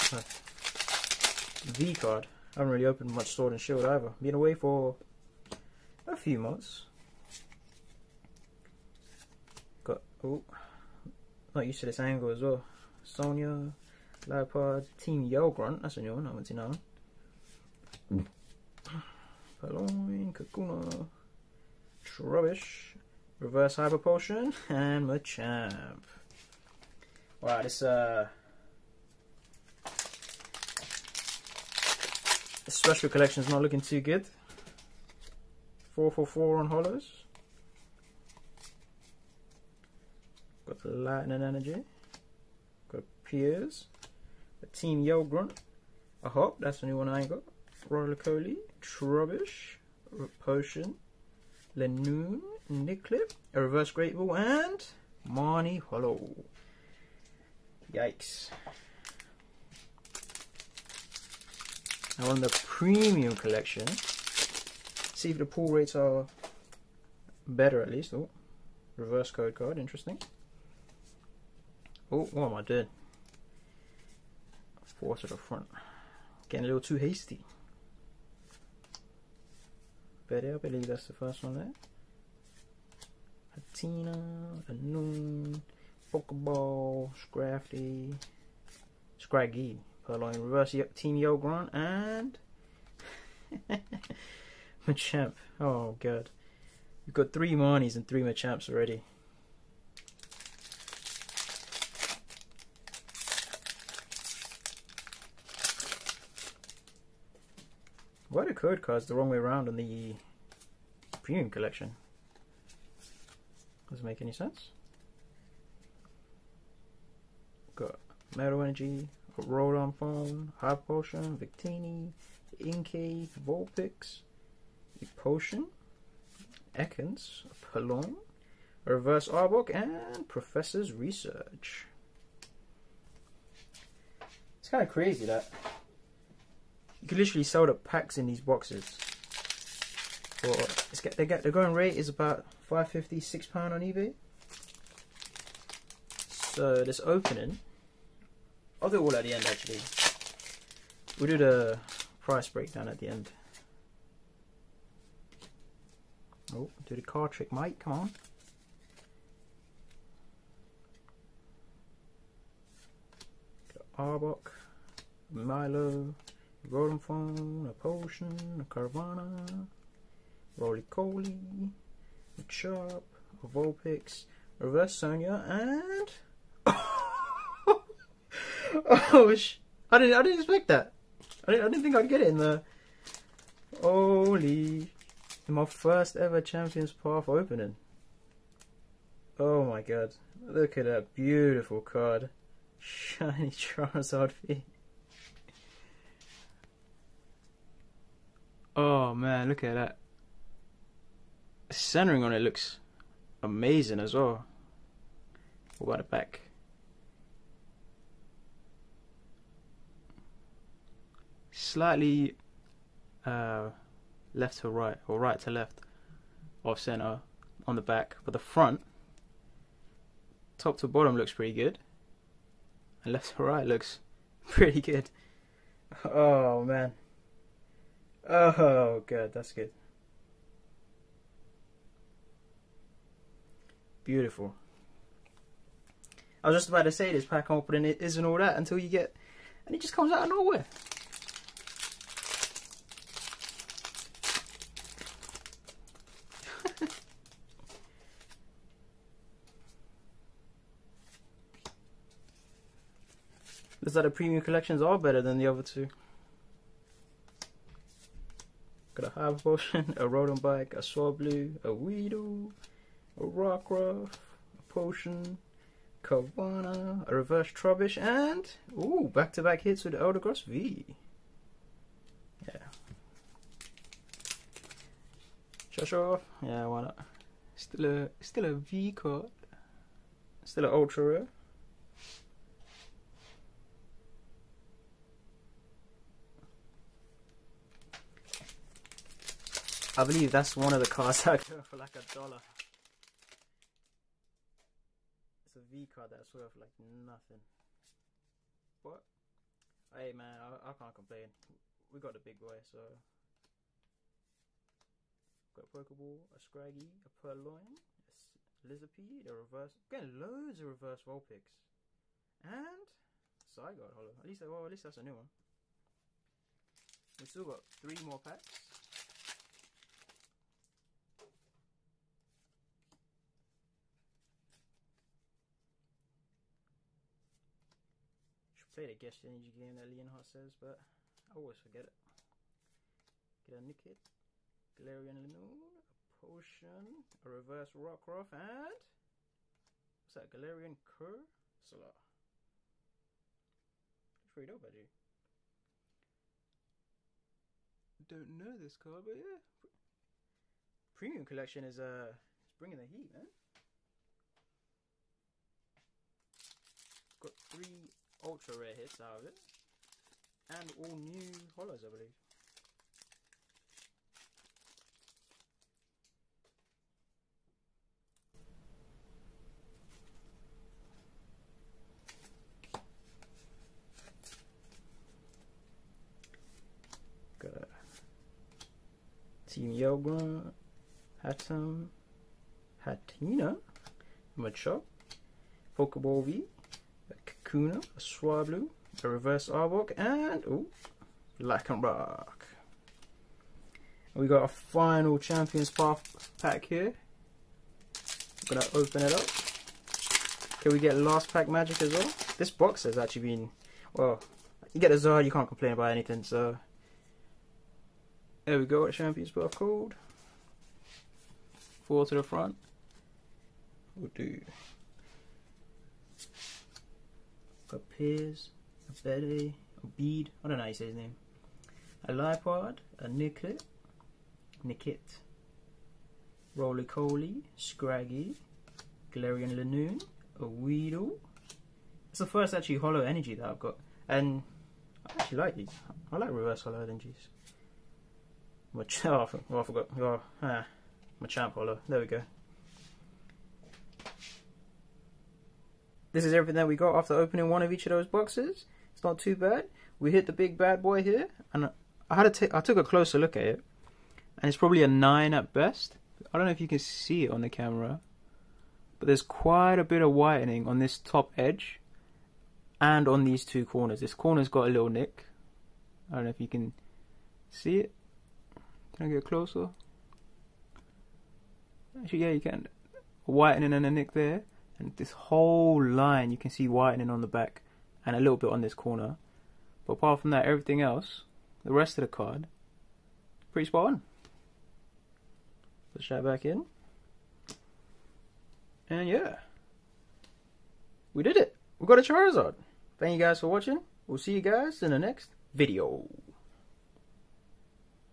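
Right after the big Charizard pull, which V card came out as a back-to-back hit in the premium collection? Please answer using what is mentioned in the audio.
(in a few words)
Eldegoss V.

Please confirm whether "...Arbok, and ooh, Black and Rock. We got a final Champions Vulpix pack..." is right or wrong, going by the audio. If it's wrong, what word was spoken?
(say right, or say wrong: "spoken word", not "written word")
wrong: "Path", not "Vulpix".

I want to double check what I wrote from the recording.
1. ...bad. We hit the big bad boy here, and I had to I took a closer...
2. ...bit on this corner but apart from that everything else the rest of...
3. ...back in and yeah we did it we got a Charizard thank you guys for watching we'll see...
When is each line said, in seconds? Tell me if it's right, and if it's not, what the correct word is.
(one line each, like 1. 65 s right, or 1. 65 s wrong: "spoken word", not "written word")
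1. 449 s right
2. 478 s right
3. 486 s right.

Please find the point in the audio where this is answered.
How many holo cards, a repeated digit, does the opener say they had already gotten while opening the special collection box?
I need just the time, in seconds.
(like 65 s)
35 s.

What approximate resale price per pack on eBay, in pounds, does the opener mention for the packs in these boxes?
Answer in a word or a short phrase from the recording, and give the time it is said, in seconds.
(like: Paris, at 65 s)
5.50, at 142 s.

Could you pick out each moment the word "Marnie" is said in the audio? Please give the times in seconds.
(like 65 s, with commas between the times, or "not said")
55 s, 97 s.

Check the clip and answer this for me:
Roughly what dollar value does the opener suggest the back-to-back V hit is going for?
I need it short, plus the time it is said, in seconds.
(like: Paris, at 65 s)
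$1, at 291 s.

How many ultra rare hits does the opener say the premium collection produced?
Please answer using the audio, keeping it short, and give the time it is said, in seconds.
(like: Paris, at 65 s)
3, at 357 s.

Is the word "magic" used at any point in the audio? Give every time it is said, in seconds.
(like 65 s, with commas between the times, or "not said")
401 s.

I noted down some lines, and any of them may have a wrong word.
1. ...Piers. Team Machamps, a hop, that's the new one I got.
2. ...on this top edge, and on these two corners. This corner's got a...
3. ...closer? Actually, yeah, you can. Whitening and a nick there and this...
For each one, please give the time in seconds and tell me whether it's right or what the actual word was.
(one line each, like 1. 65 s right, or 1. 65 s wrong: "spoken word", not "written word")
1. 43 s wrong: "Grunt", not "Machamps"
2. 460 s right
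3. 469 s right.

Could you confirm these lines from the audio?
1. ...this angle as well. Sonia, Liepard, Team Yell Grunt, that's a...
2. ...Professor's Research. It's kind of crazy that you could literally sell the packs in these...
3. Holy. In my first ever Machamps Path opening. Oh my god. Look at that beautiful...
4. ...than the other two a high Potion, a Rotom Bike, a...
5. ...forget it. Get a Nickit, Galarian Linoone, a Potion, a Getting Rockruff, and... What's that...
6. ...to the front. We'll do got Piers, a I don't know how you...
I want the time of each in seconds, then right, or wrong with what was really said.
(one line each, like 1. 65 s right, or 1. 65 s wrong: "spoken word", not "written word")
1. 11 s right
2. 130 s right
3. 183 s wrong: "Champions", not "Machamps"
4. 255 s right
5. 331 s wrong: "Reverse", not "Getting"
6. 412 s right.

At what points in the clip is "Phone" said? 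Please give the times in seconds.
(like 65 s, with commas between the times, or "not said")
119 s, 166 s.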